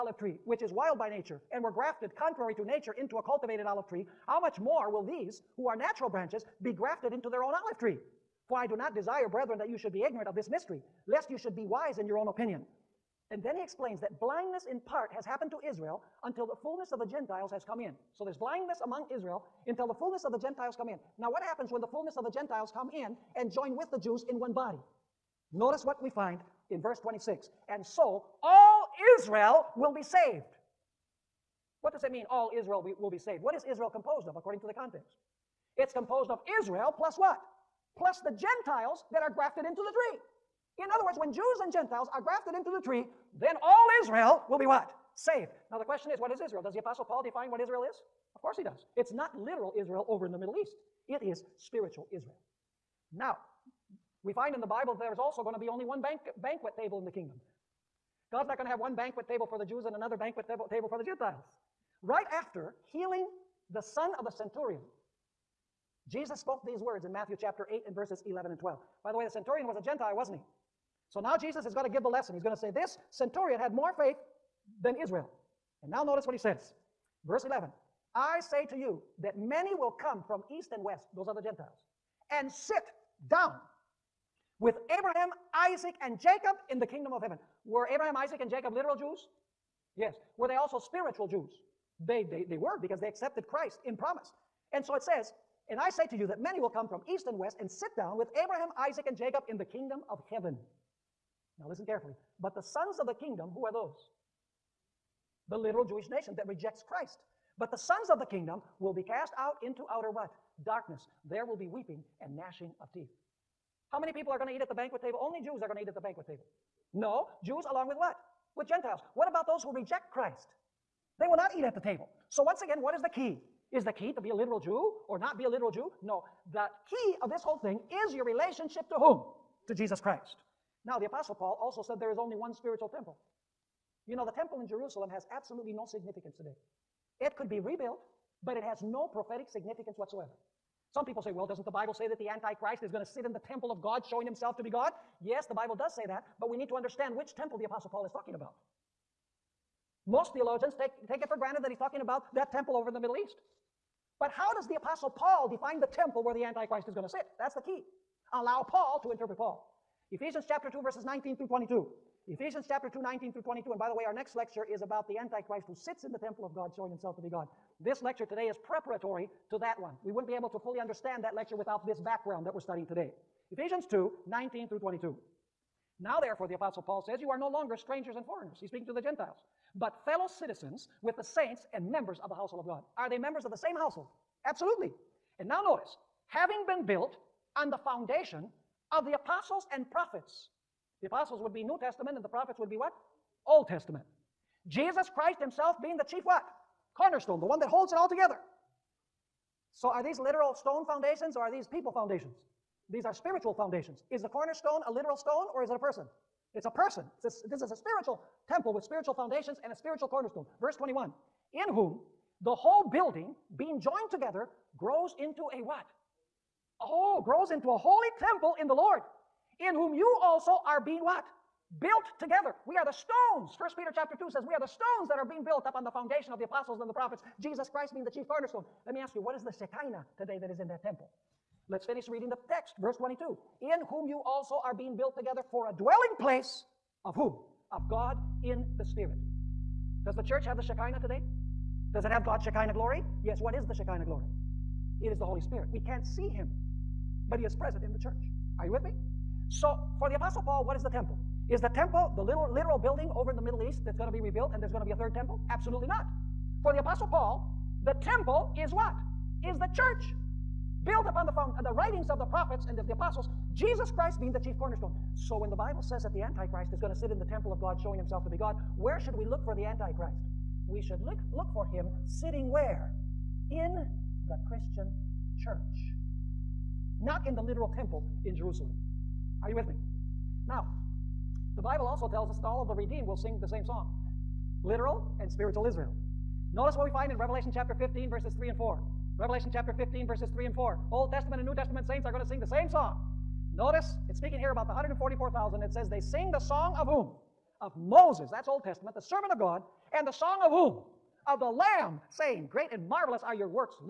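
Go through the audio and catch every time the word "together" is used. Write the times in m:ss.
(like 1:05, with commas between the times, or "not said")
3:18, 3:34, 3:42, 3:55.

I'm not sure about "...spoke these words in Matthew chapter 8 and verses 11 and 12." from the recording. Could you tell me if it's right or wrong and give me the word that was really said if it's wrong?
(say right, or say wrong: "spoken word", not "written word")
right.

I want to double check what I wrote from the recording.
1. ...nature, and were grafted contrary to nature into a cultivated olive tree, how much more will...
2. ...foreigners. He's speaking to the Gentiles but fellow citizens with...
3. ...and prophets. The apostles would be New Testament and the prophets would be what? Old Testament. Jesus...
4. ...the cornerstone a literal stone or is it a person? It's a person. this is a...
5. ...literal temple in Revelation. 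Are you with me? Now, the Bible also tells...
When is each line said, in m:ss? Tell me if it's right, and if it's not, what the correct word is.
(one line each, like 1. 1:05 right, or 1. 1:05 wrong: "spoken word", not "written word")
1. 0:01 right
2. 2:58 right
3. 3:09 right
4. 3:24 right
5. 4:37 wrong: "Jerusalem", not "Revelation".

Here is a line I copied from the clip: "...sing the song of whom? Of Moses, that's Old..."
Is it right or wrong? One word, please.
right.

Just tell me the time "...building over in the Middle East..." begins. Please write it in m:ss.
4:12.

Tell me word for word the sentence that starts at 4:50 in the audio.
Old Testament and New Testament saints are going to sing the same song.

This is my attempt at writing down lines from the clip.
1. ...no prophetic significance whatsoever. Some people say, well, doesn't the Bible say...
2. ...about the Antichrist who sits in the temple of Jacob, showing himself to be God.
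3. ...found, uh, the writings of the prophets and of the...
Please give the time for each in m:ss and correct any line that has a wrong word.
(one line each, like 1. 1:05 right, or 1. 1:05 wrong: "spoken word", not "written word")
1. 2:18 right
2. 2:44 wrong: "God", not "Jacob"
3. 4:21 right.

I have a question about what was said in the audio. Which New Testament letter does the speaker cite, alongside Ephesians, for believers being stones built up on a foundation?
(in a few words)
First Peter.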